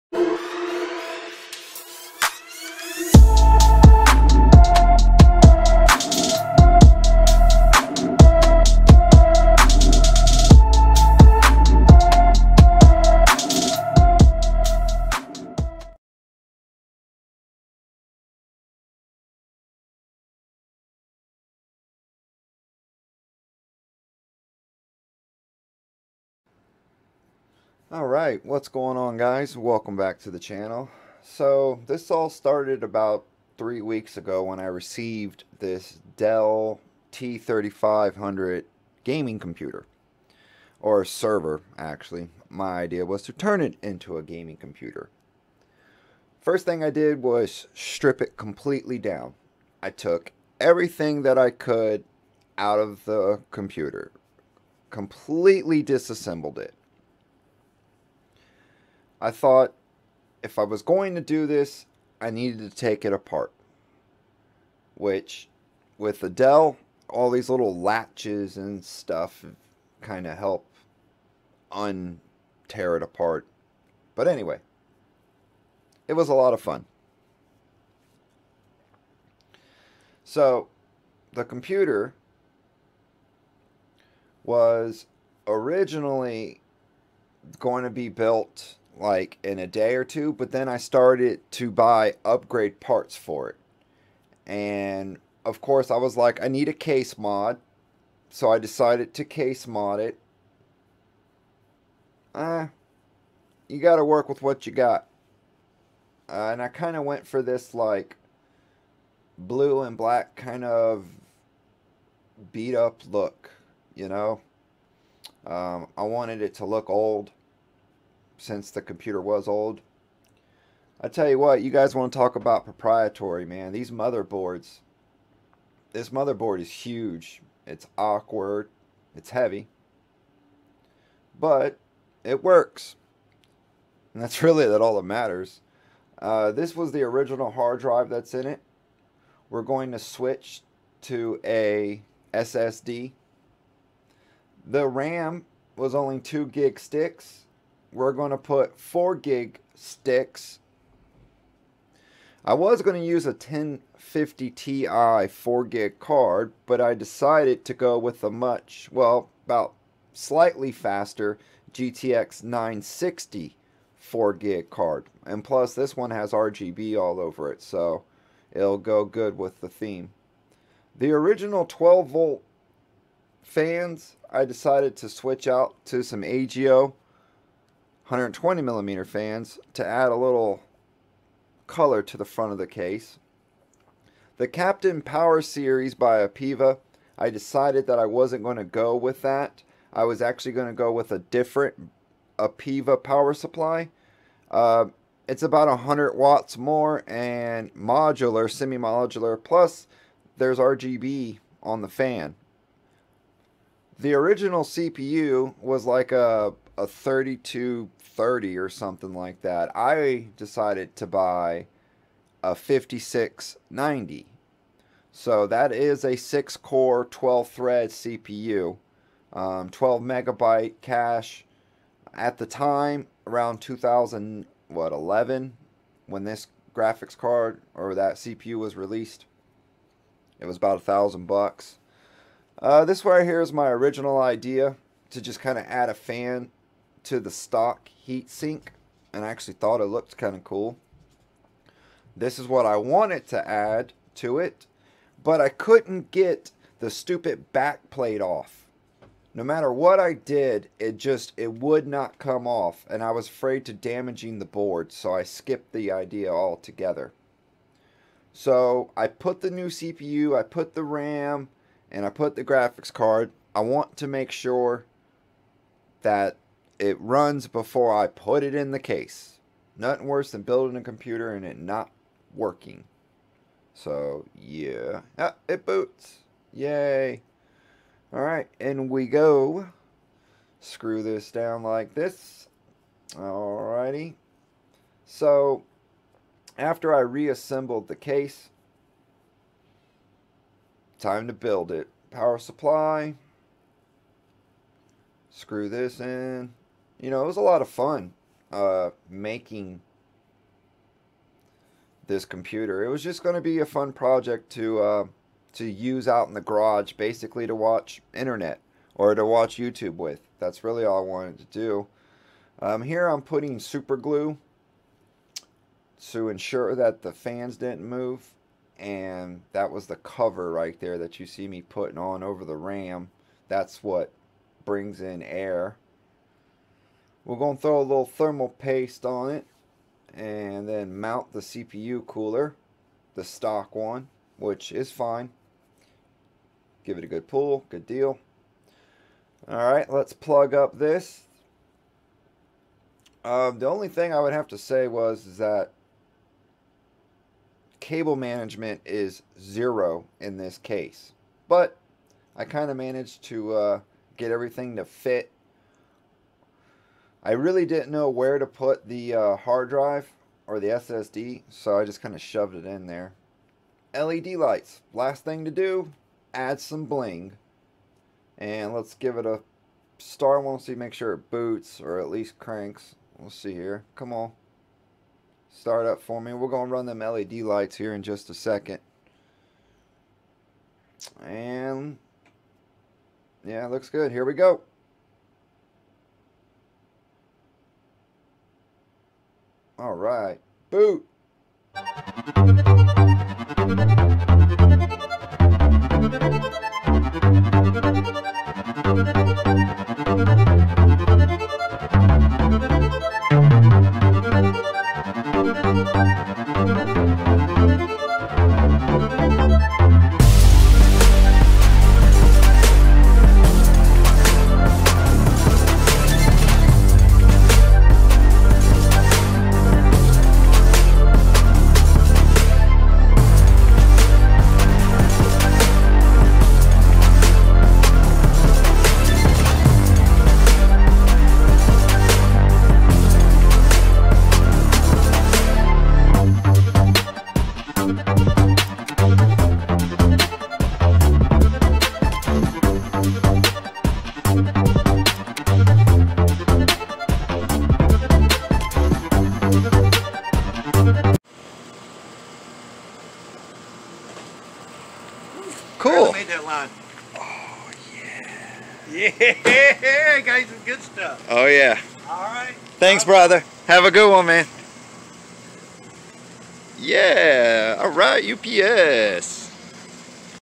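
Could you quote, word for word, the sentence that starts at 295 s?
Screw this in you know, it was a lot of fun uh, making this computer.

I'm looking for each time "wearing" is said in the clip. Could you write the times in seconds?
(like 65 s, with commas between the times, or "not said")
not said.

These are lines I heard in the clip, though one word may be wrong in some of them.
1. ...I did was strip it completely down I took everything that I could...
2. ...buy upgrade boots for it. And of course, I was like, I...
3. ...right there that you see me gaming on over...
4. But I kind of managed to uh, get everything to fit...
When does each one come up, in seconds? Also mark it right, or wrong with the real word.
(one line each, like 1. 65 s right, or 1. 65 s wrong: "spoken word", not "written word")
1. 46 s right
2. 91 s wrong: "parts", not "boots"
3. 320 s wrong: "putting", not "gaming"
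4. 351 s right.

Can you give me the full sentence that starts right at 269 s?
Nothing worse than building a computer and it not working.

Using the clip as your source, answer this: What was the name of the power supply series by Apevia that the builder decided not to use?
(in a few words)
Captain Power Series.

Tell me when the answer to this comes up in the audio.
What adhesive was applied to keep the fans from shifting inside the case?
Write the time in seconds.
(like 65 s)
313 s.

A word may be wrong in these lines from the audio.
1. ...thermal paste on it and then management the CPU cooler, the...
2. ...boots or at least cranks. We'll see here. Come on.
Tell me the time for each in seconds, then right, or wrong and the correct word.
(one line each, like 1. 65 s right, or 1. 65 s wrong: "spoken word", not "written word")
1. 328 s wrong: "mount", not "management"
2. 371 s right.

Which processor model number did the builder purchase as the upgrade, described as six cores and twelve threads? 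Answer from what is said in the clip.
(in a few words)
5690.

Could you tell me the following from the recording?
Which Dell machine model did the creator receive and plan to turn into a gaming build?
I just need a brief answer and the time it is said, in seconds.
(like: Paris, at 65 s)
T3500, at 37 s.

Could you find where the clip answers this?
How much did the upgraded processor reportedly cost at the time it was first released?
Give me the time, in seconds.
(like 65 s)
230 s.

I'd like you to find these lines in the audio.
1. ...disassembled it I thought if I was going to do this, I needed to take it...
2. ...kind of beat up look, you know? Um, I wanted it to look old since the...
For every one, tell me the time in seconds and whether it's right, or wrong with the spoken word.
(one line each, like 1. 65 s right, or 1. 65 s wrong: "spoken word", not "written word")
1. 55 s right
2. 110 s right.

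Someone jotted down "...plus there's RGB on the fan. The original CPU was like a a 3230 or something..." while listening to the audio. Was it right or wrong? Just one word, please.
right.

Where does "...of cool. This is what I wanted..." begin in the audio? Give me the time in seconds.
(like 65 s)
240 s.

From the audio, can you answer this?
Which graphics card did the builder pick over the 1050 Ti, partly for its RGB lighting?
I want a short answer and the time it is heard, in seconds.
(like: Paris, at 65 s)
GTX 960, at 161 s.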